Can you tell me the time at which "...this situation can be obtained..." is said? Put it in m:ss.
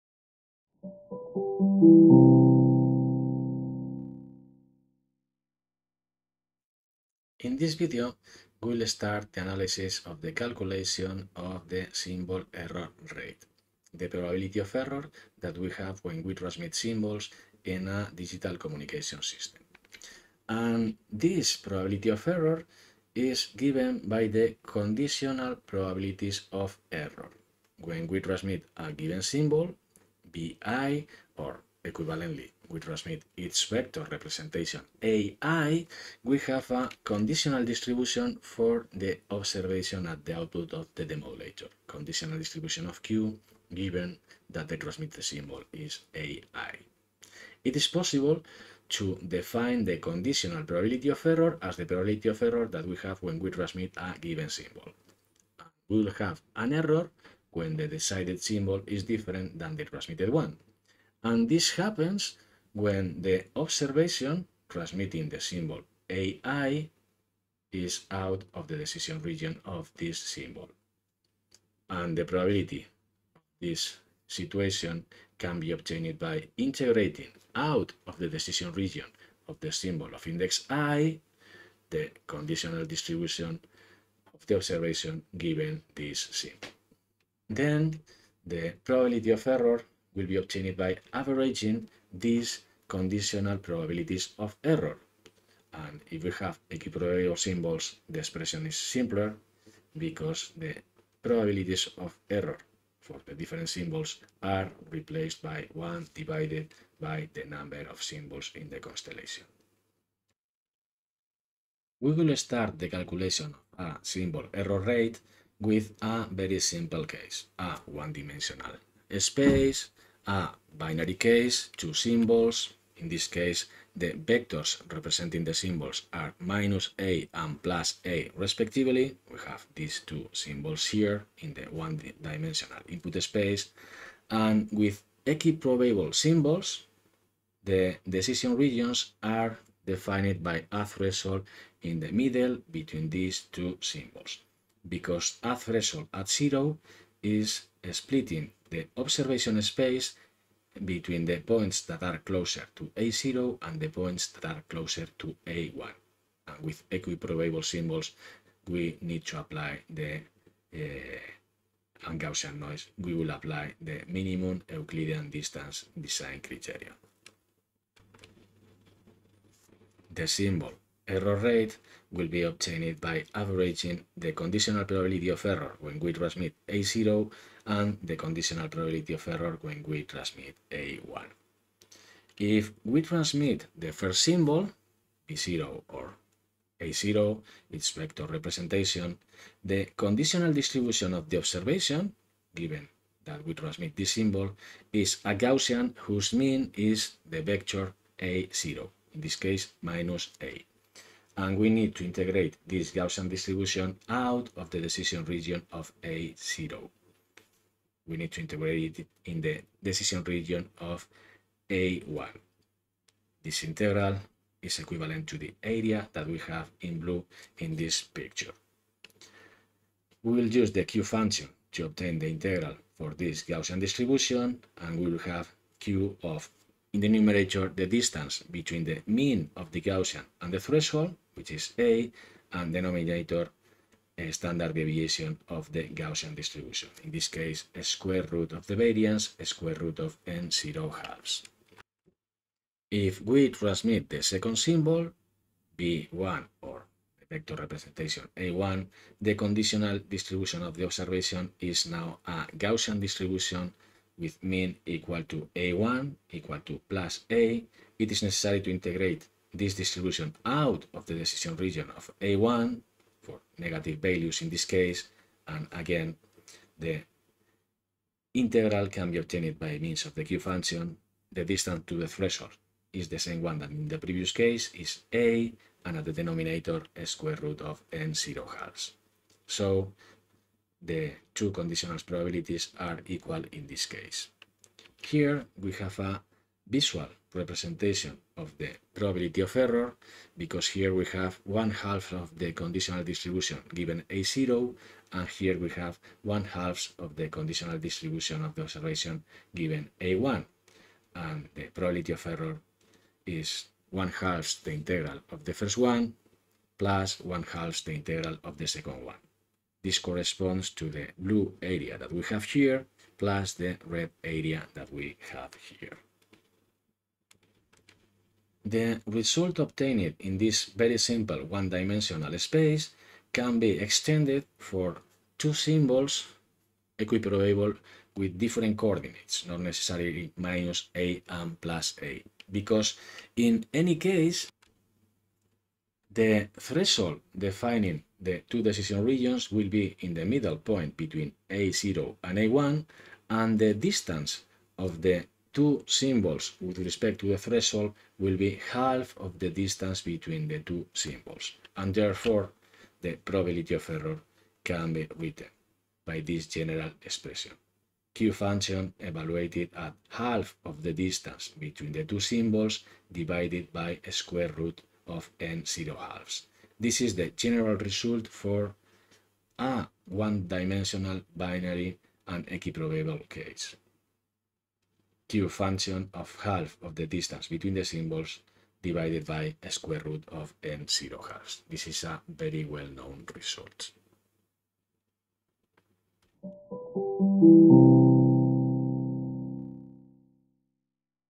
1:13.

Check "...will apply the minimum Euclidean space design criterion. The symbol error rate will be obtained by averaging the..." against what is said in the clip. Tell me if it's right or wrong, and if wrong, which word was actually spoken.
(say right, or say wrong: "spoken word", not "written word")
wrong: "distance", not "space".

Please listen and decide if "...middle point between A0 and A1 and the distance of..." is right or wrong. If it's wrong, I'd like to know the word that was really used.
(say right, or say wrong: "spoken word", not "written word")
right.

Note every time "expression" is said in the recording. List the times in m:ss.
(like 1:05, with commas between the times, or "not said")
1:38, 5:57.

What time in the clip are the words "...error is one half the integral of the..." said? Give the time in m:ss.
5:02.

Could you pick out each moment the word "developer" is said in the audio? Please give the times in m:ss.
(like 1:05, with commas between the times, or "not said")
not said.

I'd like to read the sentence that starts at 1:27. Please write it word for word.
Then the probability of error will be obtained by averaging these conditional probabilities of error.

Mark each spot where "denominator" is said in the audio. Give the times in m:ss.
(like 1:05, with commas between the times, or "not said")
3:52, 4:36.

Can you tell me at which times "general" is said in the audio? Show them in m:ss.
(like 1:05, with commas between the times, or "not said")
5:56, 6:07.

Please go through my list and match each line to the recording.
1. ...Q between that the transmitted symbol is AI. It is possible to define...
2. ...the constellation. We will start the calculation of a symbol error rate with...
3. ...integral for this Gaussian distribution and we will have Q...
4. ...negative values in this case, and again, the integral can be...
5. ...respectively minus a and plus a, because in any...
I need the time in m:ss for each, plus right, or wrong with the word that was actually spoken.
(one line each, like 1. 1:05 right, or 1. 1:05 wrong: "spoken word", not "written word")
1. 0:43 wrong: "given", not "between"
2. 1:48 right
3. 3:42 right
4. 4:23 right
5. 5:29 wrong: "necessarily", not "respectively".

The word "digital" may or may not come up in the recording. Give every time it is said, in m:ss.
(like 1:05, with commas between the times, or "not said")
0:18.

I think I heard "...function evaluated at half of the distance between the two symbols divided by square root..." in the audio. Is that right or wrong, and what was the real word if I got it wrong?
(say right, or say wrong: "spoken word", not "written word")
right.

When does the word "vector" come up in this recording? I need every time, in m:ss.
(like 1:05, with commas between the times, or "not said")
0:33, 2:04, 3:07, 3:17, 4:07.